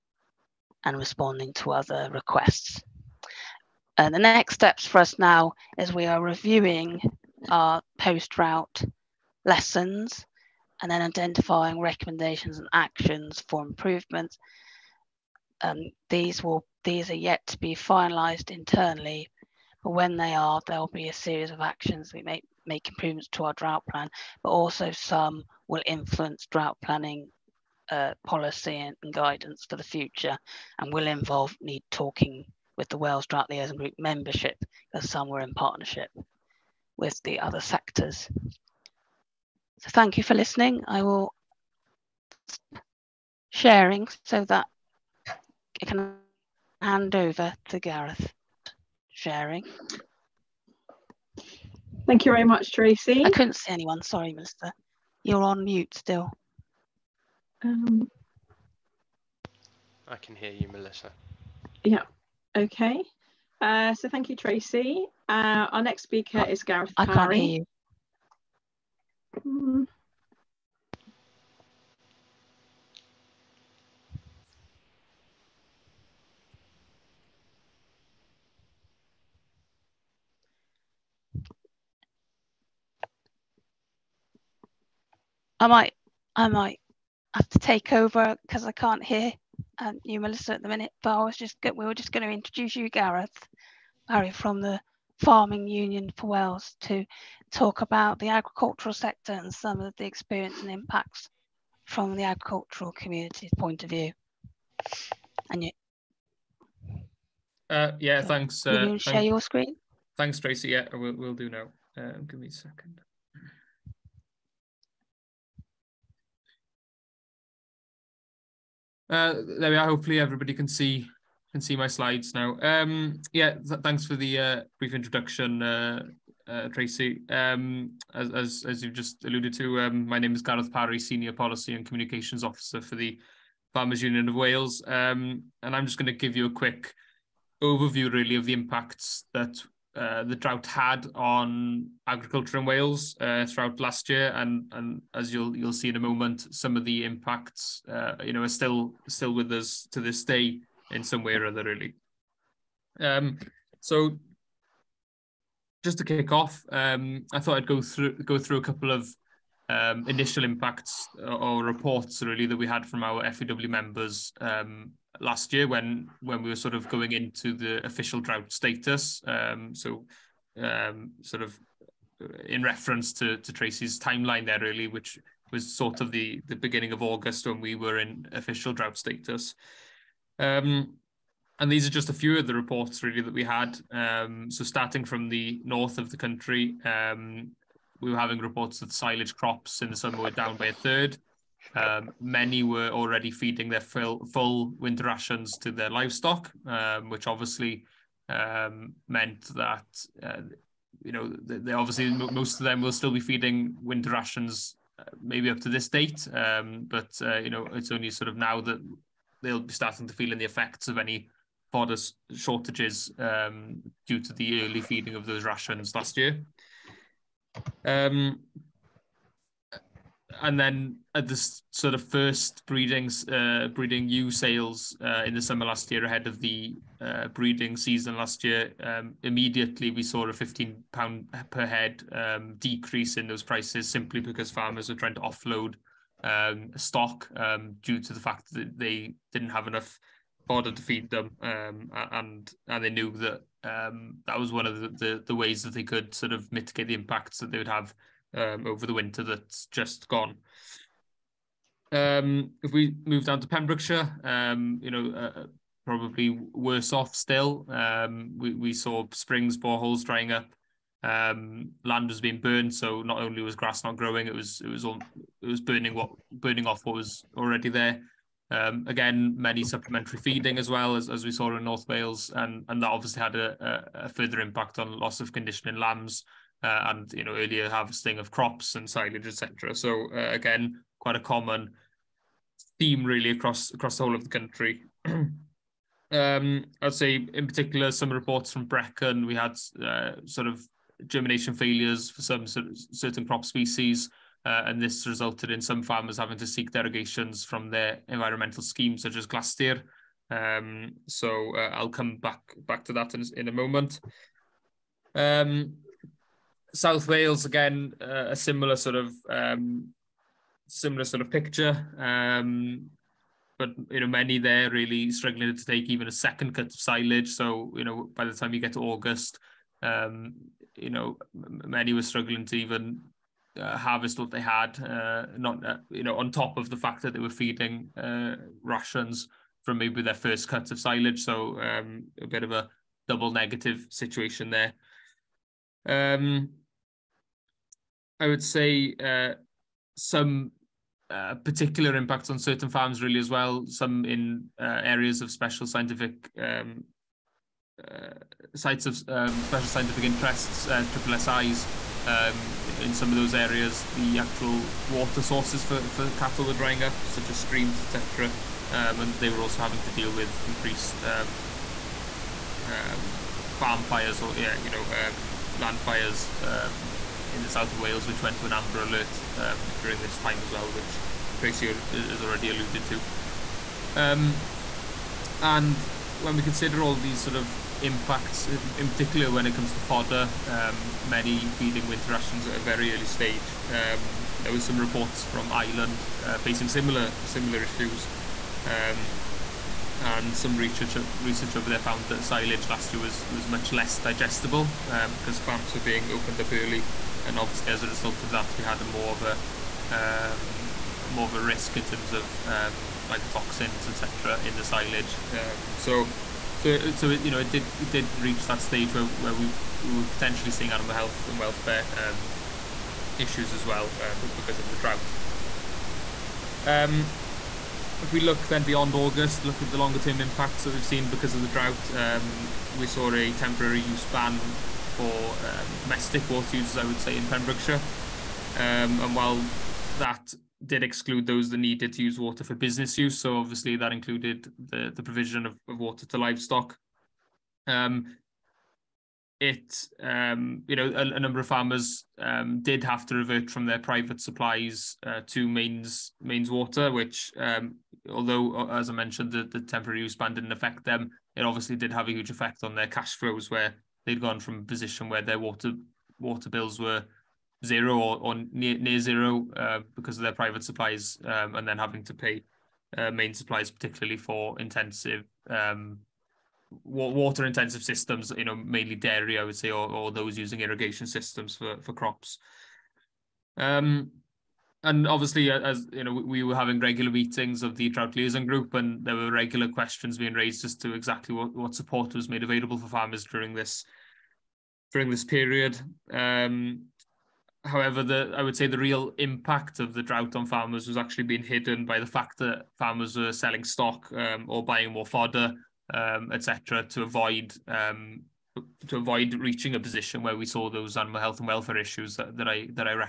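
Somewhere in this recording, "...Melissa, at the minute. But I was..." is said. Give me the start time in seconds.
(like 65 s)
90 s.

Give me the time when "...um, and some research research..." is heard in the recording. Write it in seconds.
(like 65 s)
388 s.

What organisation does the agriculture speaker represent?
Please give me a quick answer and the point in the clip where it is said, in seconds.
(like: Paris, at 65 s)
Farmers Union of Wales, at 133 s.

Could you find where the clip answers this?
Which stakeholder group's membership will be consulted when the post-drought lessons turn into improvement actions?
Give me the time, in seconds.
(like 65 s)
32 s.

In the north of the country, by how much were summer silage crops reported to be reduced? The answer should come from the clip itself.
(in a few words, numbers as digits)
A third.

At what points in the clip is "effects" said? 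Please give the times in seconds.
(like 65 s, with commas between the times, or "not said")
210 s, 452 s.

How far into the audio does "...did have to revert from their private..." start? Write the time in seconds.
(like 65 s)
442 s.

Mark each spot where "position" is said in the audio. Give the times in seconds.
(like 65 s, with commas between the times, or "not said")
454 s, 499 s.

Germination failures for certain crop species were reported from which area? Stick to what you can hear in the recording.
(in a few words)
Brecon.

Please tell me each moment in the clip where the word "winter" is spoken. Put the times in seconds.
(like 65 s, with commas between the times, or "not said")
194 s, 203 s, 248 s, 381 s.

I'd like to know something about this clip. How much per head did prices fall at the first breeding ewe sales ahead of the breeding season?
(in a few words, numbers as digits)
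£15.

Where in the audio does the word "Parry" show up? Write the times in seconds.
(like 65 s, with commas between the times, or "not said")
94 s, 130 s.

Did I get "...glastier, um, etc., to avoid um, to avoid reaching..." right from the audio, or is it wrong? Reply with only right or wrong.
wrong.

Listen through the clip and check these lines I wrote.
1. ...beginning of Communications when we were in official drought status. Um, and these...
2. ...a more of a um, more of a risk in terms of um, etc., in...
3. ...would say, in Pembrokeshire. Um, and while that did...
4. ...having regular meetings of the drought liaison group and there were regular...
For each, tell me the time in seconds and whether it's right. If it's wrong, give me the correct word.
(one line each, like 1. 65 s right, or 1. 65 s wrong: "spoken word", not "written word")
1. 176 s wrong: "August", not "Communications"
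2. 398 s right
3. 426 s right
4. 476 s right.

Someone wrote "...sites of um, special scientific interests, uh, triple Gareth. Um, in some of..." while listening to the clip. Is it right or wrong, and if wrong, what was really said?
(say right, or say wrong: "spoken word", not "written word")
wrong: "SIs", not "Gareth".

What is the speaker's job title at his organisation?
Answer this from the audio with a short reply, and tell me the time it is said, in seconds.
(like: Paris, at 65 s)
Senior Policy and Communications Officer, at 130 s.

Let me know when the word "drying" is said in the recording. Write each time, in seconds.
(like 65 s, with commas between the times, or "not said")
260 s, 356 s.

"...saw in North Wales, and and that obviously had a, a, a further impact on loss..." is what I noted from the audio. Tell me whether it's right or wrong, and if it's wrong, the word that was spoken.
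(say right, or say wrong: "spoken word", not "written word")
right.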